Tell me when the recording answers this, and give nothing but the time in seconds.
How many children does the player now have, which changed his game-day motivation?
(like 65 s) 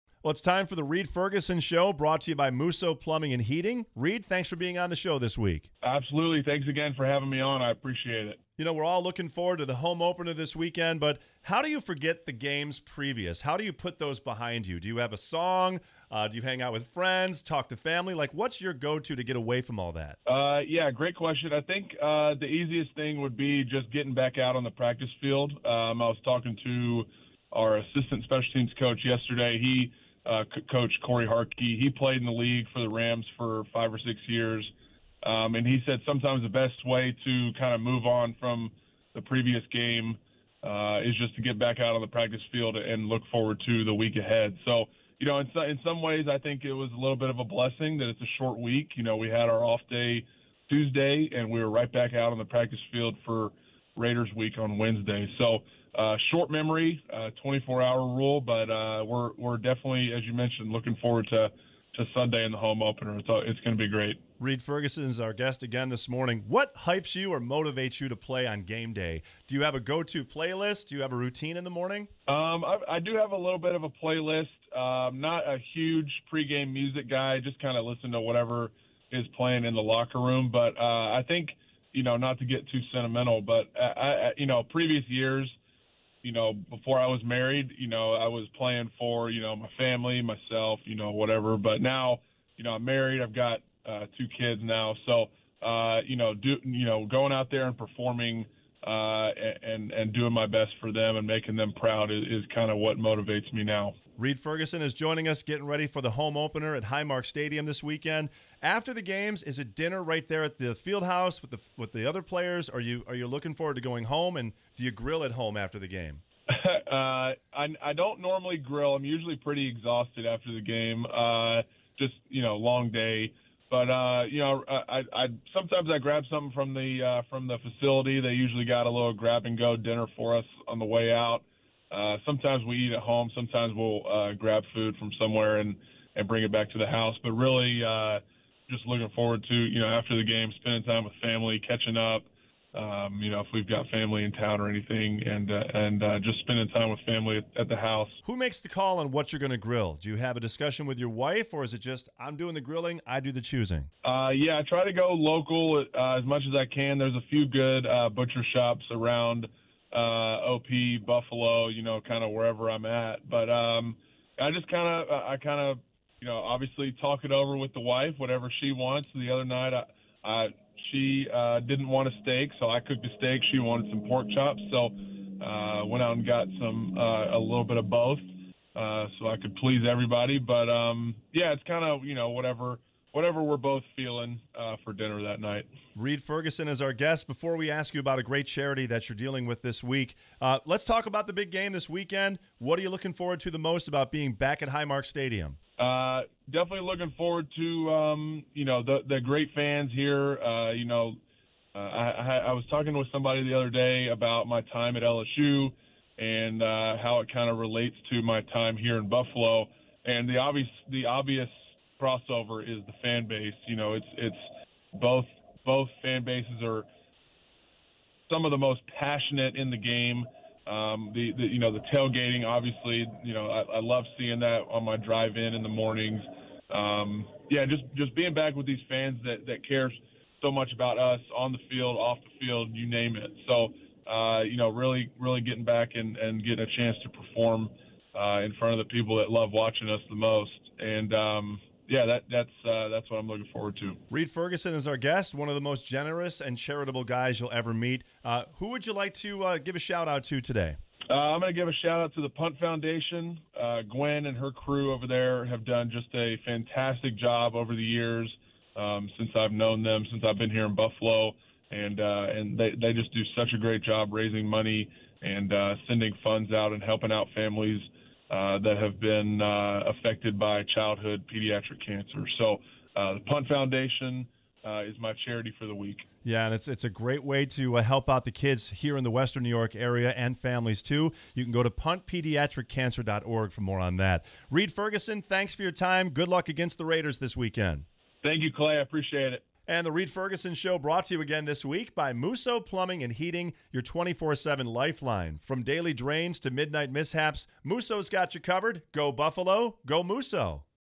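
94 s.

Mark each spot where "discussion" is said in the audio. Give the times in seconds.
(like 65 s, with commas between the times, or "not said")
150 s.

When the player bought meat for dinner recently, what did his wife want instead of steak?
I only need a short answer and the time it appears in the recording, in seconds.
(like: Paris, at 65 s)
Pork chops, at 174 s.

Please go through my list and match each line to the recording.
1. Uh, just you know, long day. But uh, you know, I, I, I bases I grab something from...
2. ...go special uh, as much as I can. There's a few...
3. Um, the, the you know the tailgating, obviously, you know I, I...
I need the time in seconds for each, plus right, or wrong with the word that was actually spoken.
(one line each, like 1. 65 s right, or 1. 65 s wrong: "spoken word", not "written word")
1. 121 s wrong: "sometimes", not "bases"
2. 154 s wrong: "local", not "special"
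3. 220 s right.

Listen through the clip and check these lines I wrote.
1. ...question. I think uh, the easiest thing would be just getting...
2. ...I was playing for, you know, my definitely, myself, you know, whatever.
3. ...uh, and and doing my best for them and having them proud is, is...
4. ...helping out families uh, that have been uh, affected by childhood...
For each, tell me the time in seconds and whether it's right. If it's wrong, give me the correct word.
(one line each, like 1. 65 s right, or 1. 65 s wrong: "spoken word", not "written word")
1. 21 s right
2. 88 s wrong: "family", not "definitely"
3. 98 s wrong: "making", not "having"
4. 266 s right.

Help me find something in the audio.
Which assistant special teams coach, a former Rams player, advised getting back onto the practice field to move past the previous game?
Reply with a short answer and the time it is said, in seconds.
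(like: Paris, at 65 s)
Cory Harkey, at 31 s.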